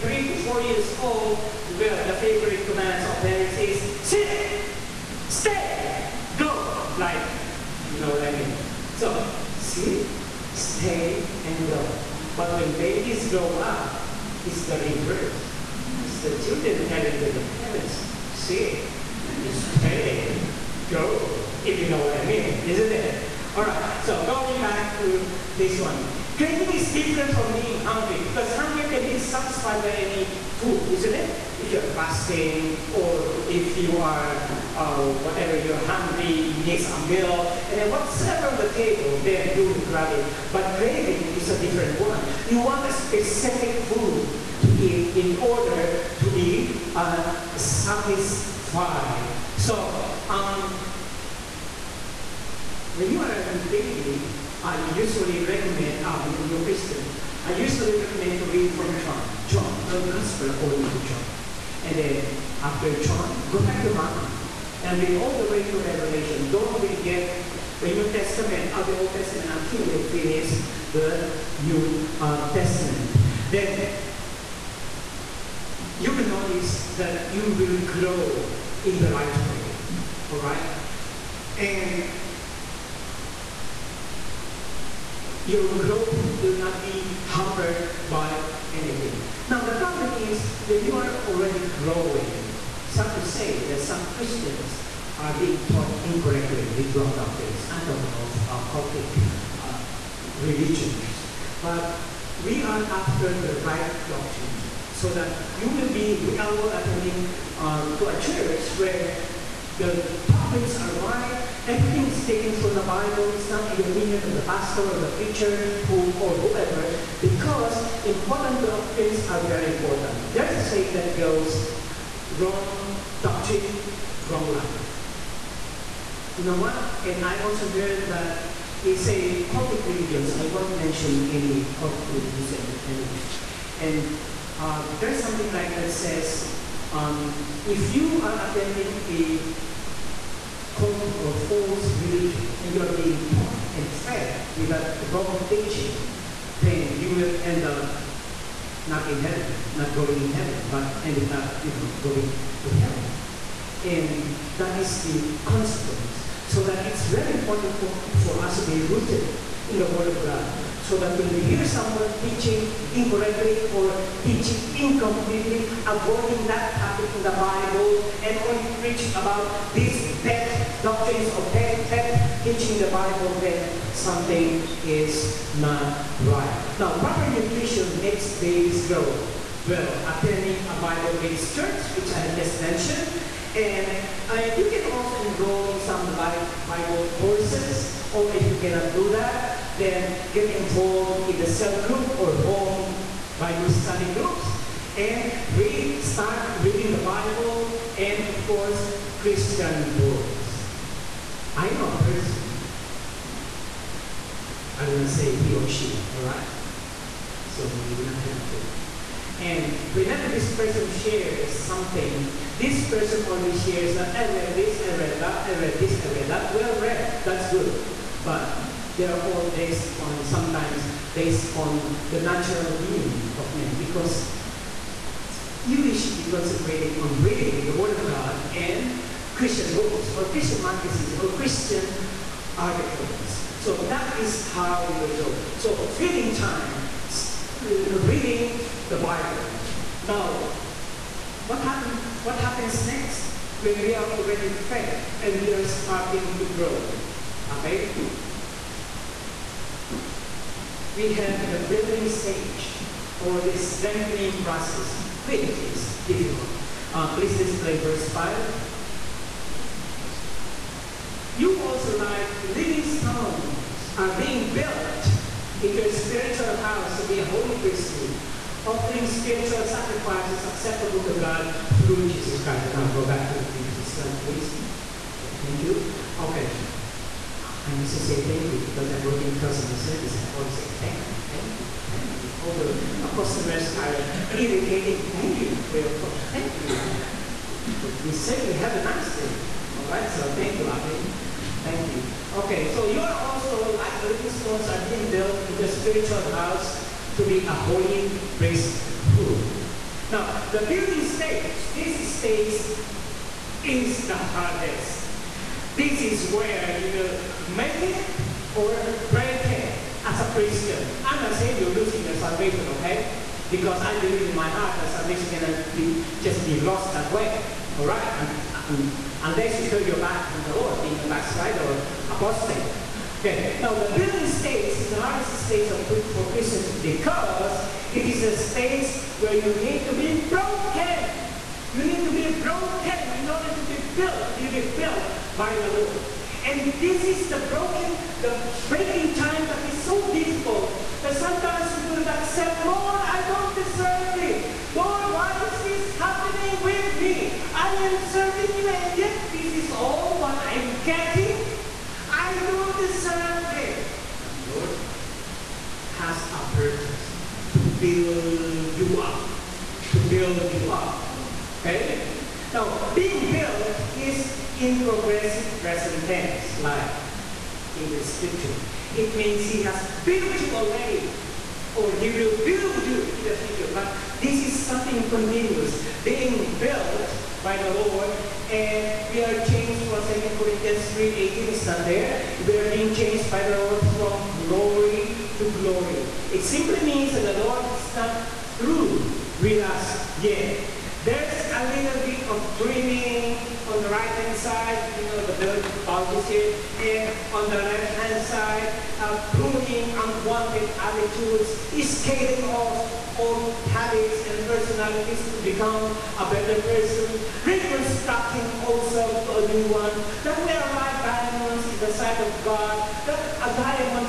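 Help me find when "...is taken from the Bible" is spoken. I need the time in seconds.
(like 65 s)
112 s.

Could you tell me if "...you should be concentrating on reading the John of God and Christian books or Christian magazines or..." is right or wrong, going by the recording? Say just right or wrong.
wrong.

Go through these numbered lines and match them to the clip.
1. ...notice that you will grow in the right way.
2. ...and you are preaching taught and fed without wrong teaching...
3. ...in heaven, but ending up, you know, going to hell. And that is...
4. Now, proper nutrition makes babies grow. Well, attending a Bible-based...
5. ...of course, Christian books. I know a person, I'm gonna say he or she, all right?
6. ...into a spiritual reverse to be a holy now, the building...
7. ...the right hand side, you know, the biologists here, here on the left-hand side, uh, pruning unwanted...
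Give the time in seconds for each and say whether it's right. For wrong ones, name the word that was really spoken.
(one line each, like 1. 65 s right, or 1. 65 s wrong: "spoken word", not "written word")
1. 76 s right
2. 142 s wrong: "being", not "preaching"
3. 150 s right
4. 176 s right
5. 198 s right
6. 295 s wrong: "house", not "reverse"
7. 393 s right.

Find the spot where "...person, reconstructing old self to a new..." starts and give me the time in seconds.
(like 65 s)
406 s.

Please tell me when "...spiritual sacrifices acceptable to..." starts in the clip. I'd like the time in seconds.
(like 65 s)
269 s.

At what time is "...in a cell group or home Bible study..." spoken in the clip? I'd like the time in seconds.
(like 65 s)
191 s.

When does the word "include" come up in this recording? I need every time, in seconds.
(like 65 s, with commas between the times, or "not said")
not said.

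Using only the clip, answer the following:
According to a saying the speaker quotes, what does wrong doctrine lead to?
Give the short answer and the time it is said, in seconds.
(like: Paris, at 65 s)
Wrong life, at 124 s.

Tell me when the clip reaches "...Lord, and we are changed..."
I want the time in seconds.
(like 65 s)
377 s.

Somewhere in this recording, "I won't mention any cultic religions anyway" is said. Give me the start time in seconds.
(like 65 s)
130 s.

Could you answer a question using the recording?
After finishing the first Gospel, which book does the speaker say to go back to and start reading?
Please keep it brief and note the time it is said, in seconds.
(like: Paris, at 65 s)
Mark, at 63 s.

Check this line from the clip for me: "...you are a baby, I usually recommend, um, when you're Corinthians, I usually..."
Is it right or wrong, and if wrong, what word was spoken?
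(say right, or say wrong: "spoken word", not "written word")
wrong: "Christian", not "Corinthians".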